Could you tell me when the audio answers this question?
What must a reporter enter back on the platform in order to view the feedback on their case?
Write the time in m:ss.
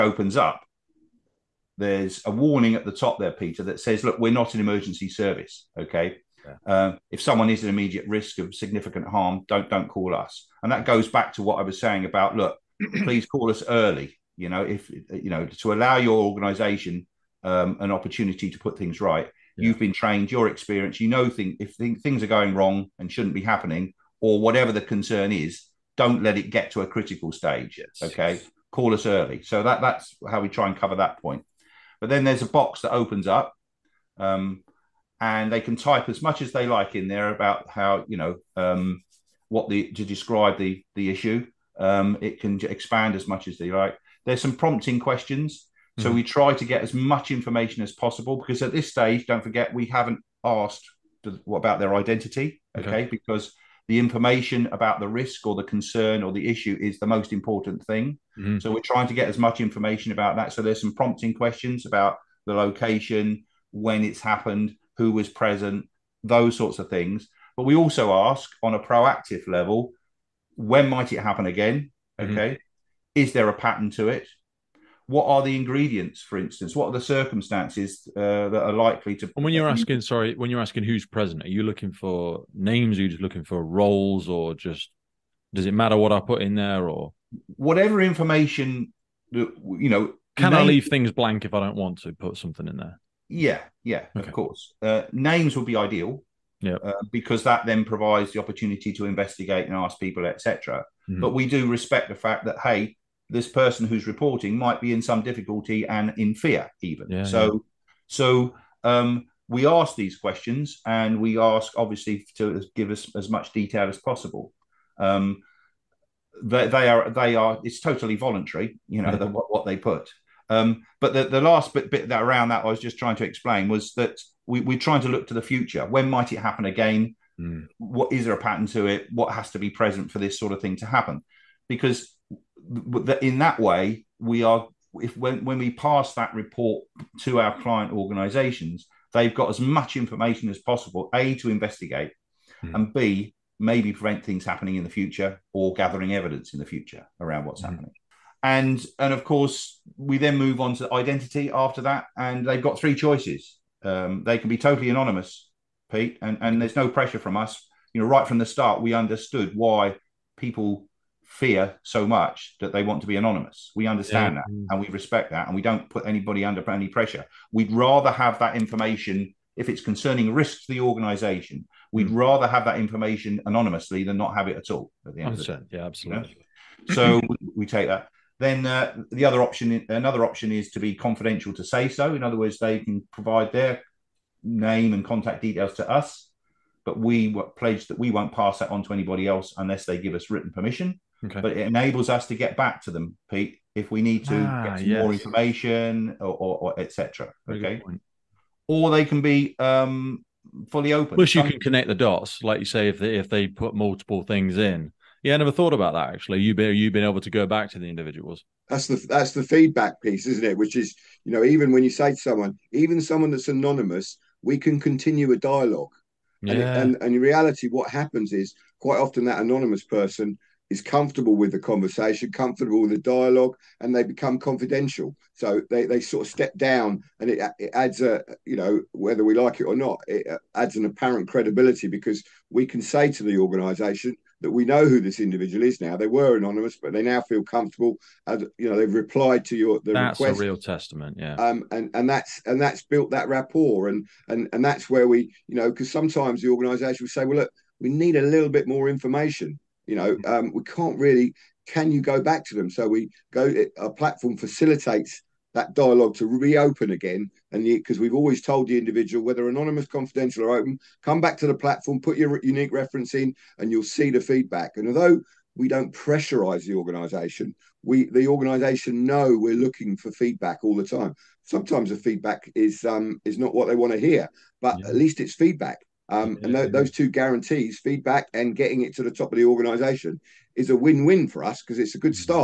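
4:22.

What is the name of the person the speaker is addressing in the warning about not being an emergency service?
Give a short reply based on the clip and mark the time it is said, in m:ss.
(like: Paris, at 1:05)
Peter, at 0:03.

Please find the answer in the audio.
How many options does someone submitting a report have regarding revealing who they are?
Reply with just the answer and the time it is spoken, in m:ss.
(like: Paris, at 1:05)
3, at 2:32.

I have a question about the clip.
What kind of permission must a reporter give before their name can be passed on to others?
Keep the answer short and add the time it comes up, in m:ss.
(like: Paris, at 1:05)
Written permission, at 3:10.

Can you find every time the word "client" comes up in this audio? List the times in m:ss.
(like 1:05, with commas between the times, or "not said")
2:17.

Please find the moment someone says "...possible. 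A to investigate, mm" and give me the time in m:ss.
2:20.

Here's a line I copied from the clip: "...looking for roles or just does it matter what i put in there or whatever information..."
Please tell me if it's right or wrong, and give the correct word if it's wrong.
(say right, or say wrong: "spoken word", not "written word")
right.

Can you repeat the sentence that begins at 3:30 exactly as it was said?
Which is you know even when you say to someone, even someone that's anonymous, we can continue a dialogue.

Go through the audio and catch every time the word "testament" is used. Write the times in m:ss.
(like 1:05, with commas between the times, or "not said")
4:00.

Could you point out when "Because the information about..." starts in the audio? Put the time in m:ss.
0:53.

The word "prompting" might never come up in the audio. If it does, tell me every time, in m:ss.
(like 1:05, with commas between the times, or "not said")
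0:44, 1:00.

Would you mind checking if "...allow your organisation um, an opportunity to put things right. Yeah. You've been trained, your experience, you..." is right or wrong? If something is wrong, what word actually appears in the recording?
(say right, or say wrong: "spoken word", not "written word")
right.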